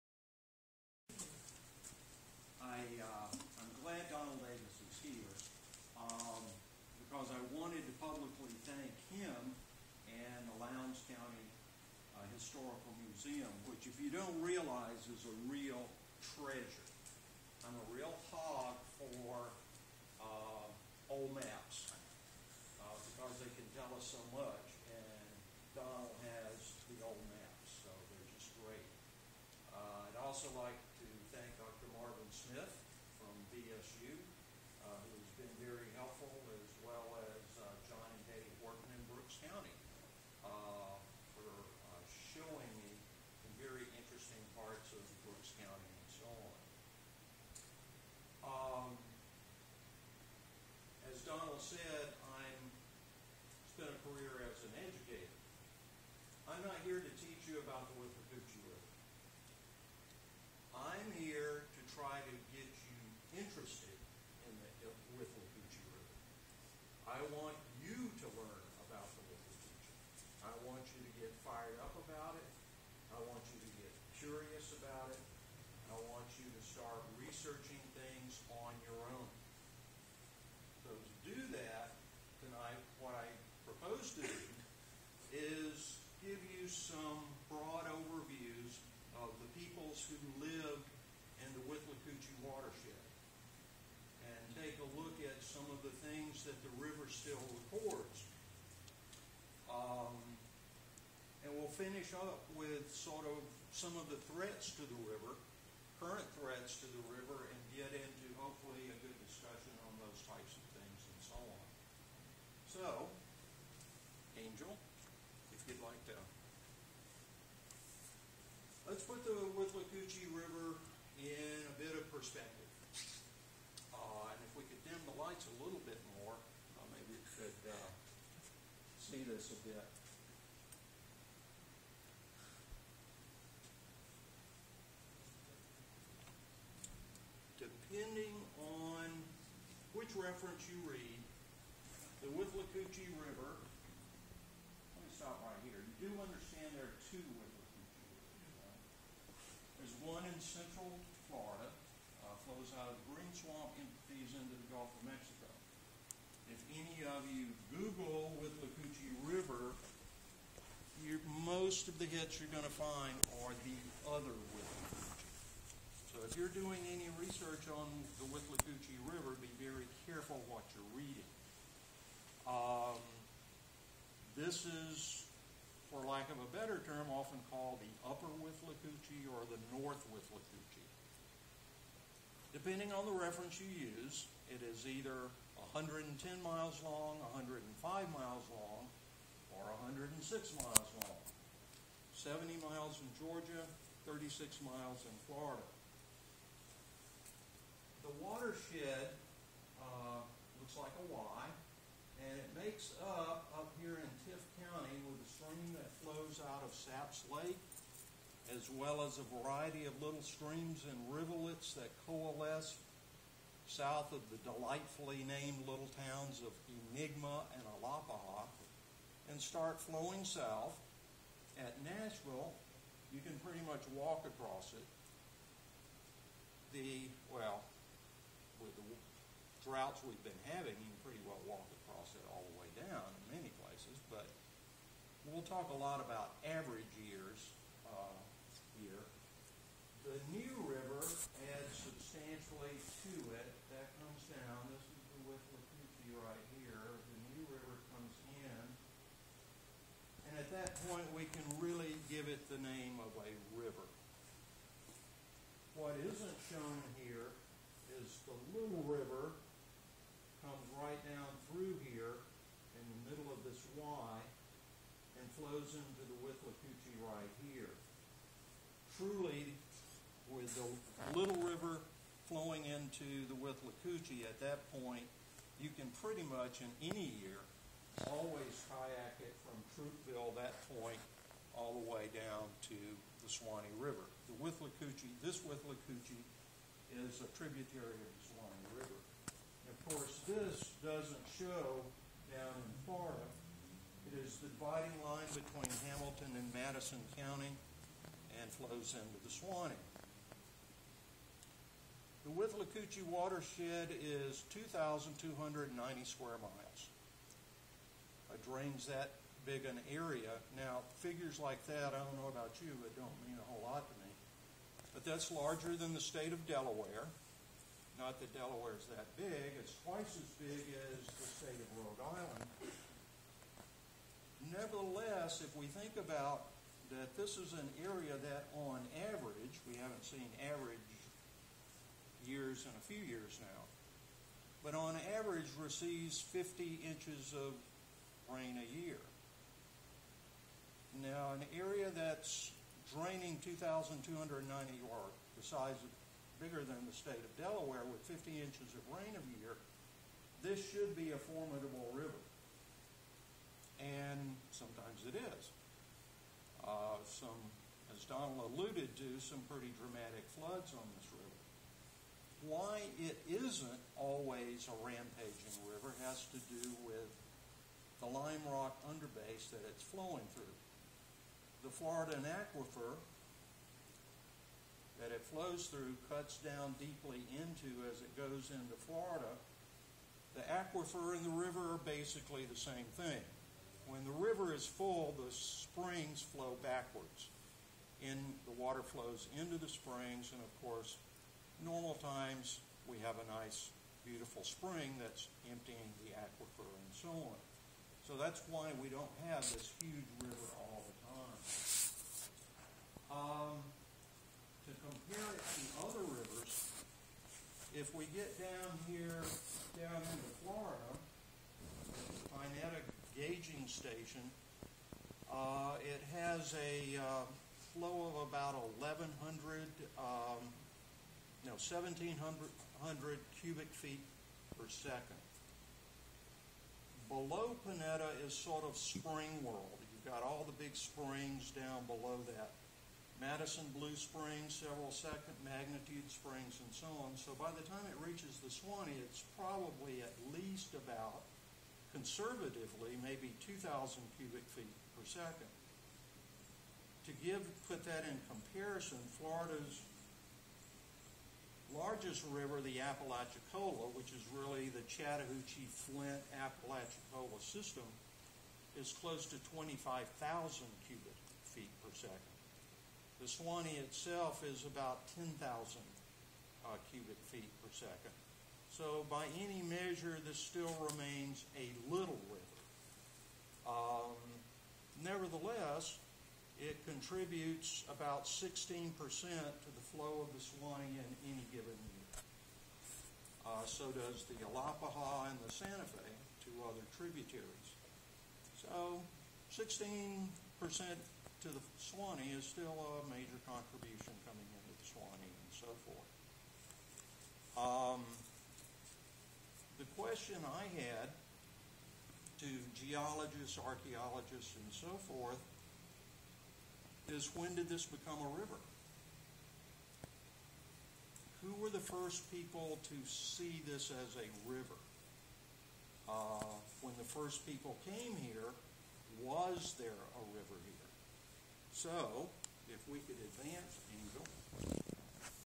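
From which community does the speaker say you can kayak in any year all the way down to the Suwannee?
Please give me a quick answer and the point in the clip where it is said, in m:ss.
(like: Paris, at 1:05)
Troupville, at 4:39.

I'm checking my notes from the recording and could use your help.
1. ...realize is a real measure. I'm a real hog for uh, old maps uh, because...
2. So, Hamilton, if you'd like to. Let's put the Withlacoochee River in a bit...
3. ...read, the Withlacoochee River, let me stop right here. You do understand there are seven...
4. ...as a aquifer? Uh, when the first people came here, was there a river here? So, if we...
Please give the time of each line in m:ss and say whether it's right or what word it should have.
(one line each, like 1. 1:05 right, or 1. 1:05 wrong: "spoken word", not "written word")
1. 0:14 wrong: "treasure", not "measure"
2. 1:52 wrong: "Angel", not "Hamilton"
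3. 2:20 wrong: "two", not "seven"
4. 8:33 wrong: "river", not "aquifer".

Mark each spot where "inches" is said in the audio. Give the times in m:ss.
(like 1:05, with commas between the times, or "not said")
5:36, 5:48.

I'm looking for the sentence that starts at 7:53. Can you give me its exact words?
Um, nevertheless, it contributes about 16% to the flow of the Suwannee in any given year.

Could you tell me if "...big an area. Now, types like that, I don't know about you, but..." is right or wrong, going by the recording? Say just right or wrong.
wrong.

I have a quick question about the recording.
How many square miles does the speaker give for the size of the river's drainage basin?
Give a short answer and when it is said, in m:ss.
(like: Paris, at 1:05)
2,290, at 5:04.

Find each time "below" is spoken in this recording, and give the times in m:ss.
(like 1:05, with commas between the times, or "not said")
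7:07, 7:11.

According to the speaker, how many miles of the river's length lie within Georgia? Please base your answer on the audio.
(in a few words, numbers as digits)
70.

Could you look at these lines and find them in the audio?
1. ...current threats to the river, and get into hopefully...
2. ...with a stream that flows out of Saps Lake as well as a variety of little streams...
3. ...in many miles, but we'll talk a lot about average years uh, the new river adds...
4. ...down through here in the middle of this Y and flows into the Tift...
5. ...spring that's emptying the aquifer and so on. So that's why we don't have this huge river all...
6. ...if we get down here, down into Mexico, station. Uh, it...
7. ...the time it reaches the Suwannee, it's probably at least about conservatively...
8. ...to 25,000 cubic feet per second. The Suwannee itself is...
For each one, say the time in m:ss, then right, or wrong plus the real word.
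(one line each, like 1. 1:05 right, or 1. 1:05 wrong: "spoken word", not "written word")
1. 1:46 right
2. 3:25 right
3. 3:53 wrong: "places", not "miles"
4. 4:21 wrong: "Withlacoochee", not "Tift"
5. 6:34 right
6. 6:47 wrong: "Florida", not "Mexico"
7. 7:17 right
8. 7:39 right.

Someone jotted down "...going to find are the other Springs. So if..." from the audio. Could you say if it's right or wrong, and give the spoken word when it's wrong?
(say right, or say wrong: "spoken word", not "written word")
wrong: "Withlacoochee", not "Springs".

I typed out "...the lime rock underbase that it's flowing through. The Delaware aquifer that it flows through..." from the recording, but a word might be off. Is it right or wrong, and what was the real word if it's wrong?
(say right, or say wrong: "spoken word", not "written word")
wrong: "Florida", not "Delaware".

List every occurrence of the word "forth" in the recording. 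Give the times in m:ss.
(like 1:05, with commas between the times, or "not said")
8:15, 8:25.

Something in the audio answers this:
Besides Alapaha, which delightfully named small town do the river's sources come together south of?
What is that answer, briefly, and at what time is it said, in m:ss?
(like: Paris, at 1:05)
Enigma, at 3:36.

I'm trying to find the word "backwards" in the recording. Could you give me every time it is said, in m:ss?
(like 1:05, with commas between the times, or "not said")
6:26.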